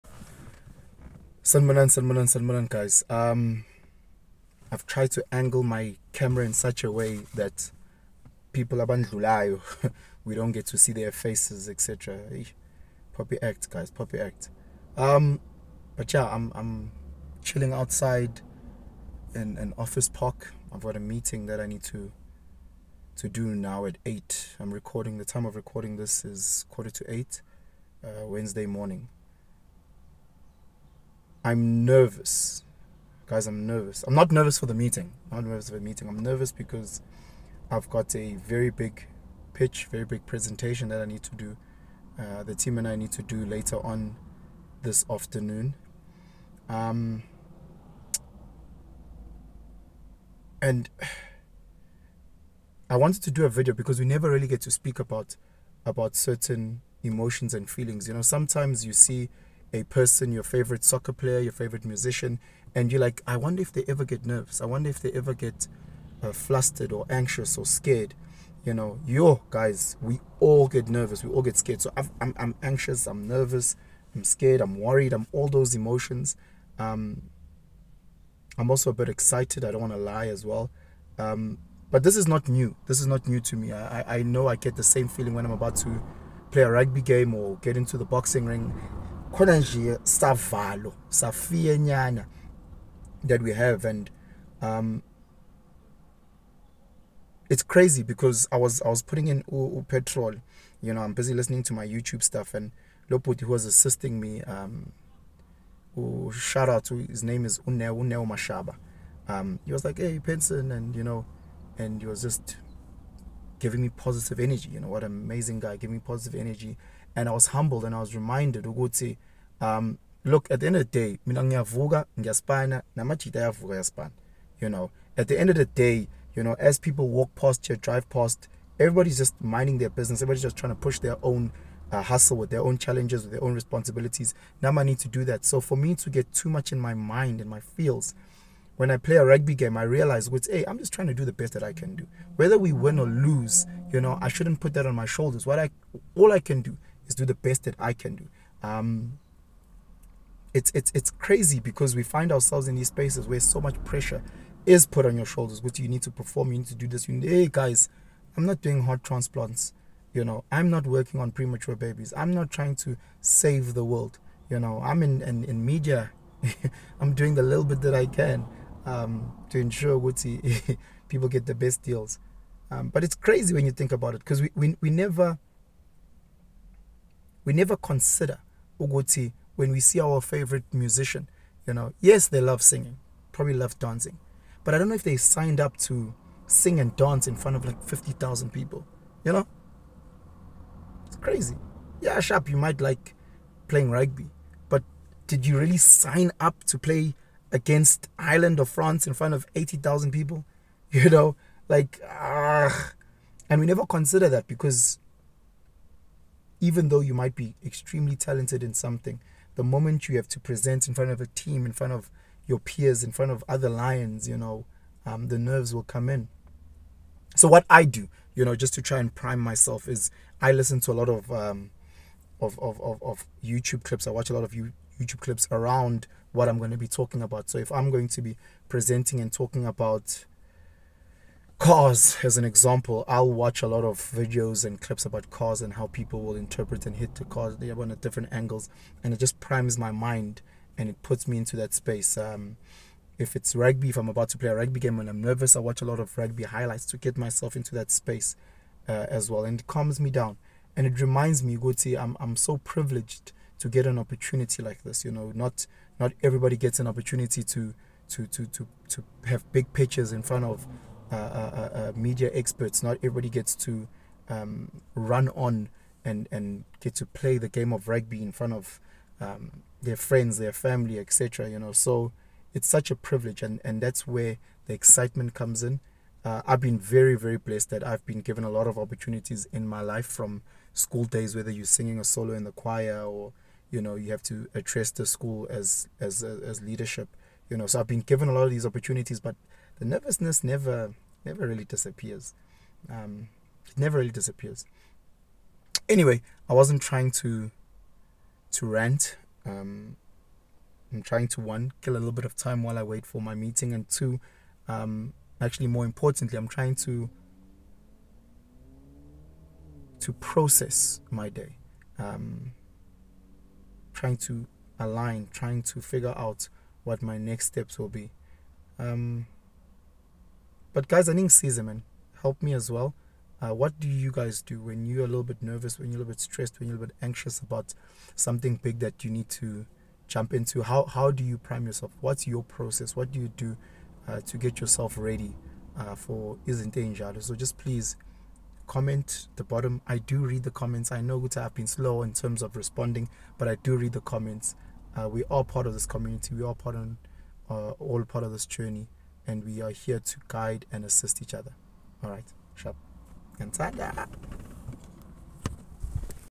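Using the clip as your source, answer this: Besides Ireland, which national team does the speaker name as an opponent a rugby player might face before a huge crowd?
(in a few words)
France.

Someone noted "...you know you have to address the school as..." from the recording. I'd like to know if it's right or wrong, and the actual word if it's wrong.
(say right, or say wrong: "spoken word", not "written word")
right.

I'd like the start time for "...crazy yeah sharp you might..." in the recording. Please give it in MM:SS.
03:11.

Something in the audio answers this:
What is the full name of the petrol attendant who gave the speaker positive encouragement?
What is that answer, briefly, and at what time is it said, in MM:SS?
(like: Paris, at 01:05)
Uneo Mashaba, at 01:48.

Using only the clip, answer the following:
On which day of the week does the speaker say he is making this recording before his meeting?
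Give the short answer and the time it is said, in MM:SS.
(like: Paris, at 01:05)
Wednesday, at 00:28.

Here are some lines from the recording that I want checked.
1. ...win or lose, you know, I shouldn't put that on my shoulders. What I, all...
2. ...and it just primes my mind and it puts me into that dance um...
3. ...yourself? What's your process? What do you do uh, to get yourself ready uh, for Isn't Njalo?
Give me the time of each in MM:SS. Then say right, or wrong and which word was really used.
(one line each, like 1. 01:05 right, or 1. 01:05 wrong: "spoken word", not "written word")
1. 02:22 right
2. 03:59 wrong: "space", not "dance"
3. 05:31 right.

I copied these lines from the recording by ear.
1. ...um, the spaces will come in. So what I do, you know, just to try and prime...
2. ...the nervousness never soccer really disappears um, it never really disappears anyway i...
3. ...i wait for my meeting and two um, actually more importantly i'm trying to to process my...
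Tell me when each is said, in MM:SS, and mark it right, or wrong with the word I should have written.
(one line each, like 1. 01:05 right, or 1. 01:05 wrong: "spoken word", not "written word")
1. 03:35 wrong: "nerves", not "spaces"
2. 04:49 wrong: "never", not "soccer"
3. 05:02 right.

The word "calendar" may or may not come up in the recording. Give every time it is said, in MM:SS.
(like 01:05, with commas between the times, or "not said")
not said.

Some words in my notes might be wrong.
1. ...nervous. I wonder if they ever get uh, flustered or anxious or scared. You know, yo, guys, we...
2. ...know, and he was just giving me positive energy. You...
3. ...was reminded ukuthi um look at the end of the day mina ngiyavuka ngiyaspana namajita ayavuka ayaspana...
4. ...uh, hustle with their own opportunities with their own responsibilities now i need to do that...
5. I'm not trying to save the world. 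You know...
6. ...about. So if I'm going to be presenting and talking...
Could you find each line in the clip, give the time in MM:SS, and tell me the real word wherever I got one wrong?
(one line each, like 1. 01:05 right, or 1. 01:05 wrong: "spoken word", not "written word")
1. 01:04 right
2. 01:51 right
3. 01:57 right
4. 02:11 wrong: "challenges", not "opportunities"
5. 02:42 right
6. 03:47 right.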